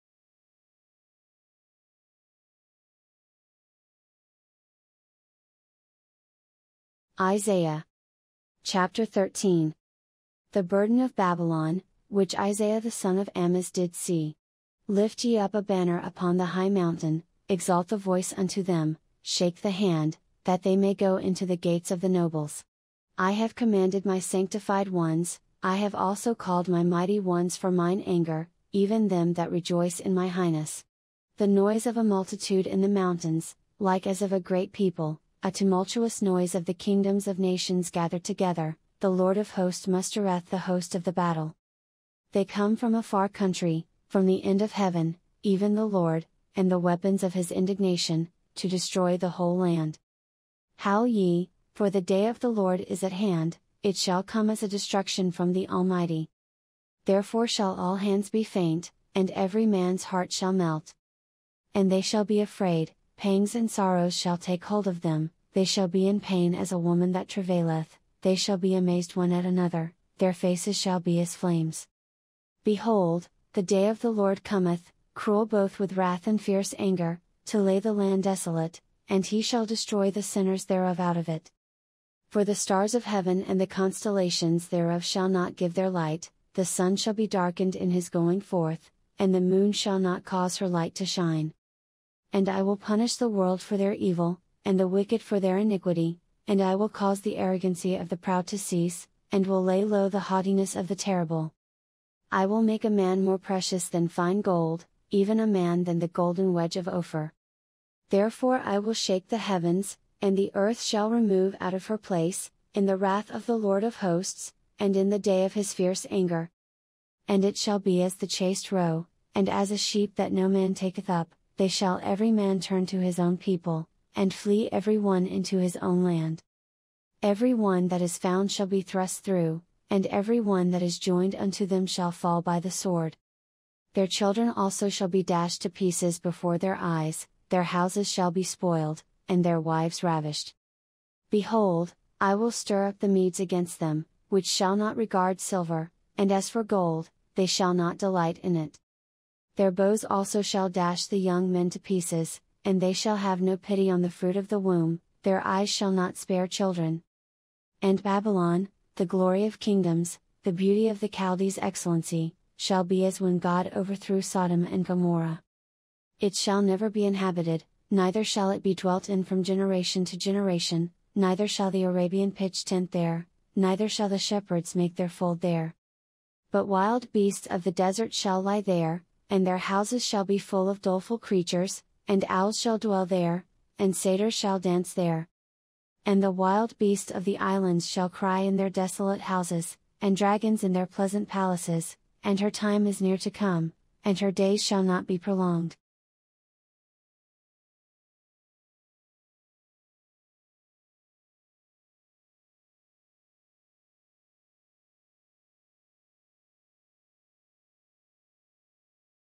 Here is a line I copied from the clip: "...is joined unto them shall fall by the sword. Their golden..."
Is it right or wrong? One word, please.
wrong.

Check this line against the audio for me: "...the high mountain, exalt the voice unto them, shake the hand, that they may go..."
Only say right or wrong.
right.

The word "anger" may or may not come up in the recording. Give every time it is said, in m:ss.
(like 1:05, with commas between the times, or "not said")
0:28, 1:16, 1:56.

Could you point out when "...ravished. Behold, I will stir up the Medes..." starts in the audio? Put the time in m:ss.
2:20.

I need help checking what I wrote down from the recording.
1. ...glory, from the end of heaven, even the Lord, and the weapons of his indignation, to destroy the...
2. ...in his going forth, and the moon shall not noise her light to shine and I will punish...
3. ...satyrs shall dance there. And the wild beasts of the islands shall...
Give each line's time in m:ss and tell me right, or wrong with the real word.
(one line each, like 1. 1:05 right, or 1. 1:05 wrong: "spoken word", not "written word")
1. 0:43 wrong: "country", not "glory"
2. 1:27 wrong: "cause", not "noise"
3. 3:03 right.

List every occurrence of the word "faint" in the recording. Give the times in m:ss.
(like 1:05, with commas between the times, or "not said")
0:58.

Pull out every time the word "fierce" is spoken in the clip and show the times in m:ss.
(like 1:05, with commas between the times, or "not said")
1:16, 1:55.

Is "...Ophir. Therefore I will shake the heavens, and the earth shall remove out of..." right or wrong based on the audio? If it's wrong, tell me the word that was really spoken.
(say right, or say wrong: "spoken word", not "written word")
right.